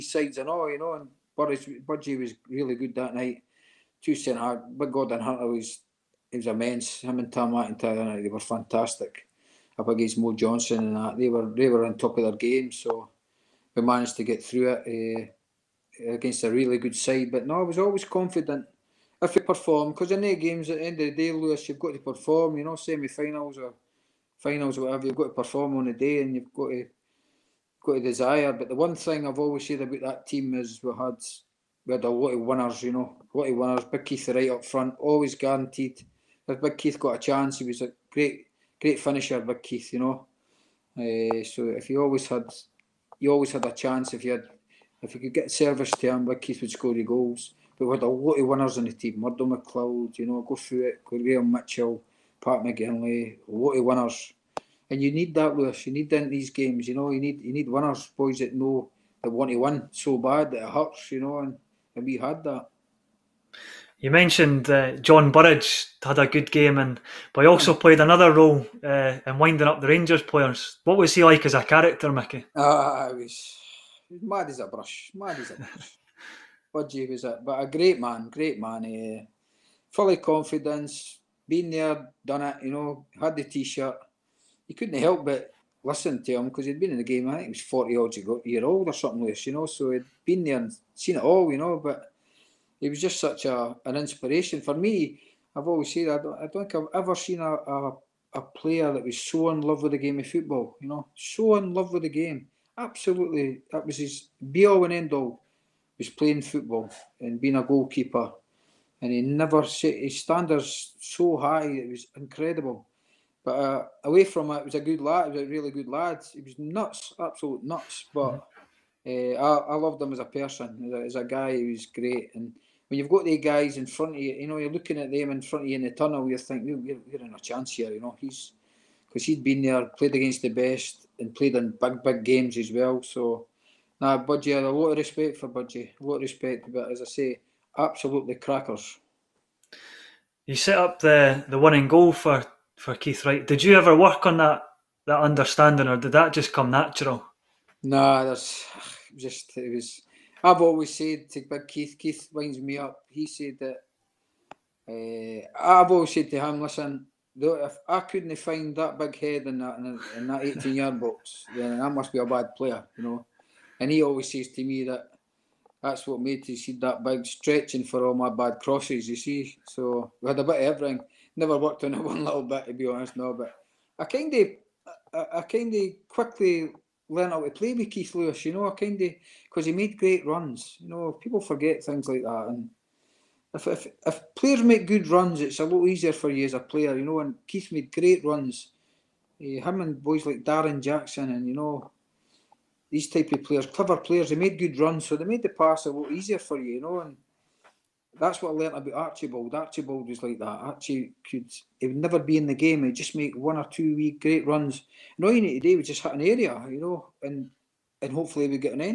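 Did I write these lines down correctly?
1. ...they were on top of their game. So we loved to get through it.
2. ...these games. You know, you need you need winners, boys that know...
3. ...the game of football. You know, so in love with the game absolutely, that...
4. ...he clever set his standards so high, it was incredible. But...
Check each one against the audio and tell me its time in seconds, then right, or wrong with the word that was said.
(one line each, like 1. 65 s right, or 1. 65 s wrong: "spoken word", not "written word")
1. 11 s wrong: "managed", not "loved"
2. 56 s right
3. 99 s right
4. 109 s wrong: "never", not "clever".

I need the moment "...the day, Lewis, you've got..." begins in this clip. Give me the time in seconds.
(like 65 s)
21 s.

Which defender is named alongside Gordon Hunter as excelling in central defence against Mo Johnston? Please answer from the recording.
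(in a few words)
Tom McIntyre.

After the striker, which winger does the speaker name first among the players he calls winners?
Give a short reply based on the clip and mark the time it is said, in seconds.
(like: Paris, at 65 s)
Murdo McLeod, at 49 s.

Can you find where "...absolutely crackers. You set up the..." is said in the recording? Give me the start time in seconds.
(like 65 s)
137 s.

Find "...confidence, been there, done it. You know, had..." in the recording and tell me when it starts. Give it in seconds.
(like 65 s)
80 s.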